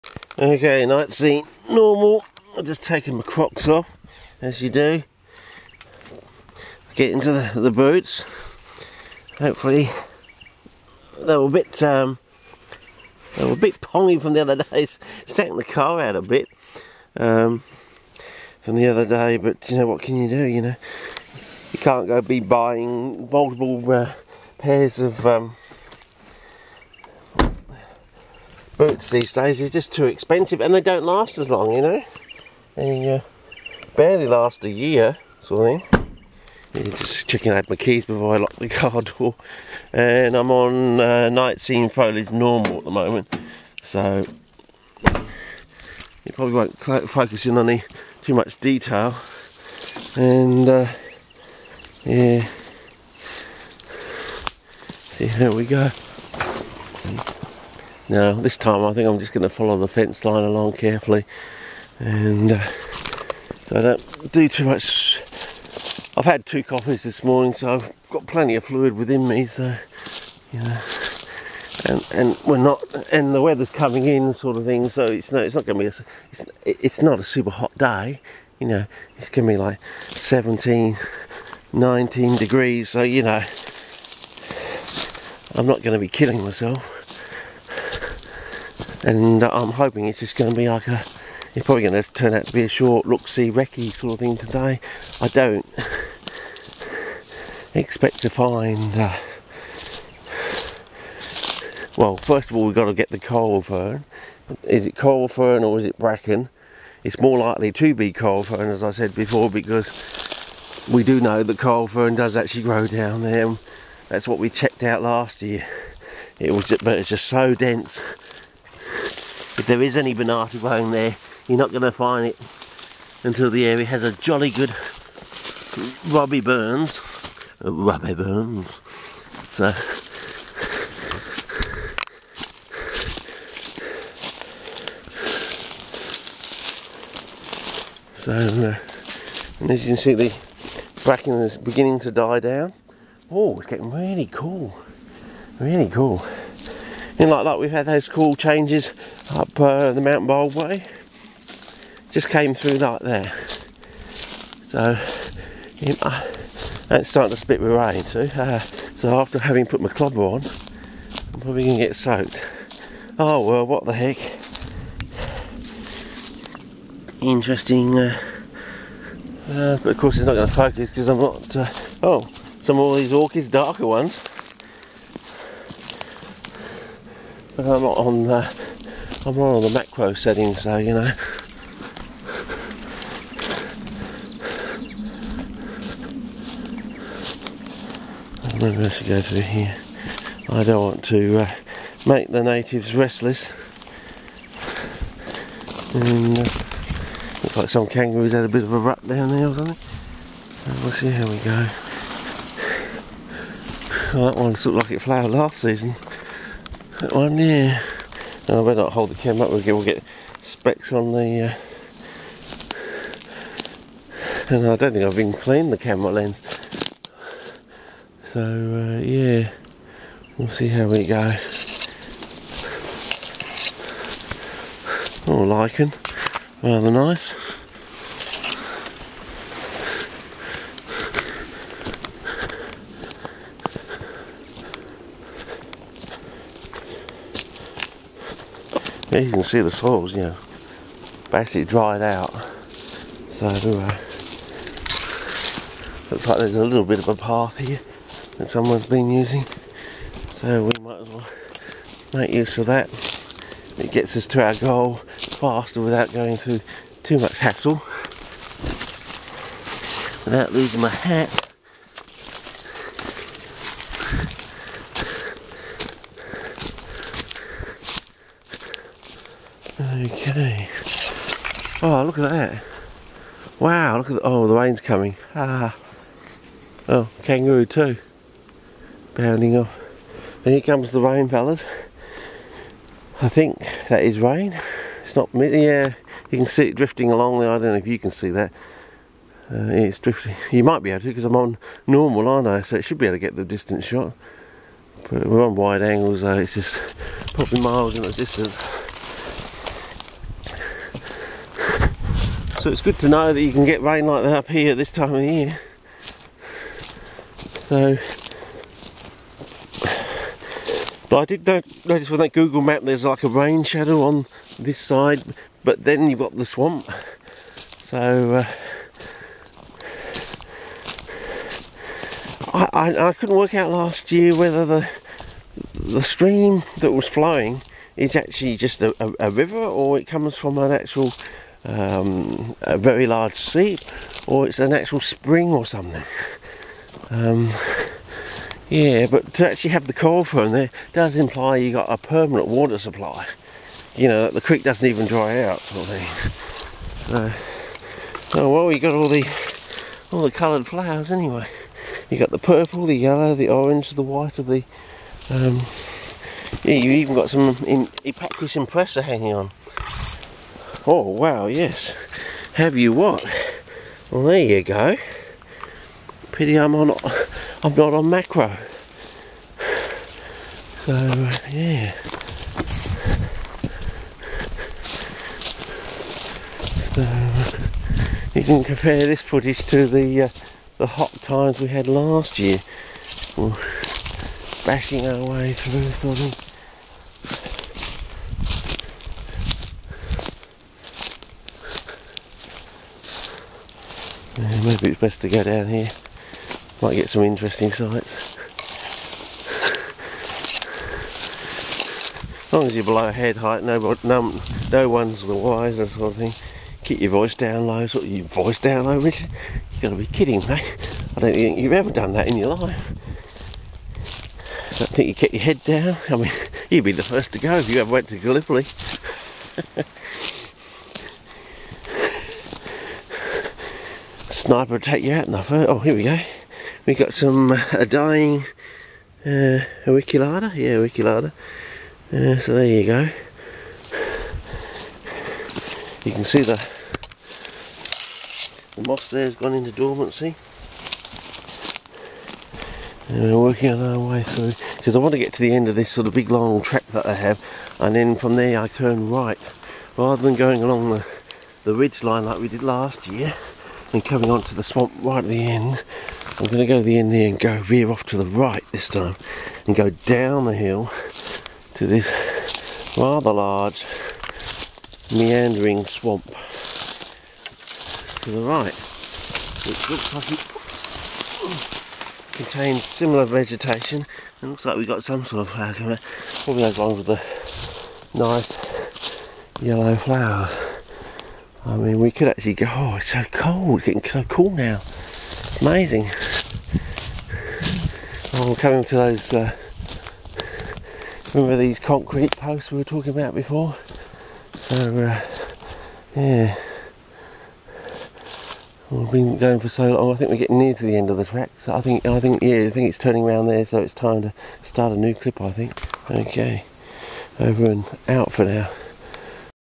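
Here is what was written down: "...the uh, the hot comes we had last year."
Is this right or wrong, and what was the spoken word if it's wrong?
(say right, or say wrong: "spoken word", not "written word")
wrong: "times", not "comes".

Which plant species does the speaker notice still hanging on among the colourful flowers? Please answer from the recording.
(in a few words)
Epacris impressa.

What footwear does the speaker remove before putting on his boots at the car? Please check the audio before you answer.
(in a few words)
Crocs.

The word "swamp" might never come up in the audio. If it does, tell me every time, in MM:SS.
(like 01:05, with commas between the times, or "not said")
05:16, 07:34, 07:45.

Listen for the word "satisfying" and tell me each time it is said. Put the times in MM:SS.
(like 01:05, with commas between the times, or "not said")
not said.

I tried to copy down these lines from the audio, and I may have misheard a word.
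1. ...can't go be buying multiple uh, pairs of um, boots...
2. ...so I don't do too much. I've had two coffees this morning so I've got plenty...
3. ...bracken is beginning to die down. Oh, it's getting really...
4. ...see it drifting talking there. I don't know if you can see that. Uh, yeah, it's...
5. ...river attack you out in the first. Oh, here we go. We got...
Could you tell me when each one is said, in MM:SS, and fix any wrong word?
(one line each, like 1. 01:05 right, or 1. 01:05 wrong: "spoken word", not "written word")
1. 00:21 right
2. 01:03 right
3. 02:21 right
4. 04:46 wrong: "along", not "talking"
5. 07:04 wrong: "sniper", not "river".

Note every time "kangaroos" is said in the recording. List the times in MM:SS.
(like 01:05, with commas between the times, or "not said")
03:17, 04:37.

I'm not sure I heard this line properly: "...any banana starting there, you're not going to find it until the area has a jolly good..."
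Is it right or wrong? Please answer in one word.
wrong.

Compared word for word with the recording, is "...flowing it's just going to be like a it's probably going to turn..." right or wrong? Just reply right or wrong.
wrong.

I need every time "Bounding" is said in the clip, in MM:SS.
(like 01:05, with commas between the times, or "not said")
04:39.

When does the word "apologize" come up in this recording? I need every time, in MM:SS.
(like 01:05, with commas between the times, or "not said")
not said.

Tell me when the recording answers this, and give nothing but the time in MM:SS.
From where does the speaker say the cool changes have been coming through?
02:30.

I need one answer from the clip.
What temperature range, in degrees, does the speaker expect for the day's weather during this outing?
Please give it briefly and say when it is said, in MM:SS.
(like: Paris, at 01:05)
17 to 19, at 01:20.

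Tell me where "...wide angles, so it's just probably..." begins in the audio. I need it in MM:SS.
04:55.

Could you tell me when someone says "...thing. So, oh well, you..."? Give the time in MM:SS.
05:45.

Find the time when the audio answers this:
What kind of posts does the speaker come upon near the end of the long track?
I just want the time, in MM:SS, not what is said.
08:11.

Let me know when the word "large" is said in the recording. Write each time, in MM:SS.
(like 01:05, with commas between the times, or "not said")
05:33, 07:43.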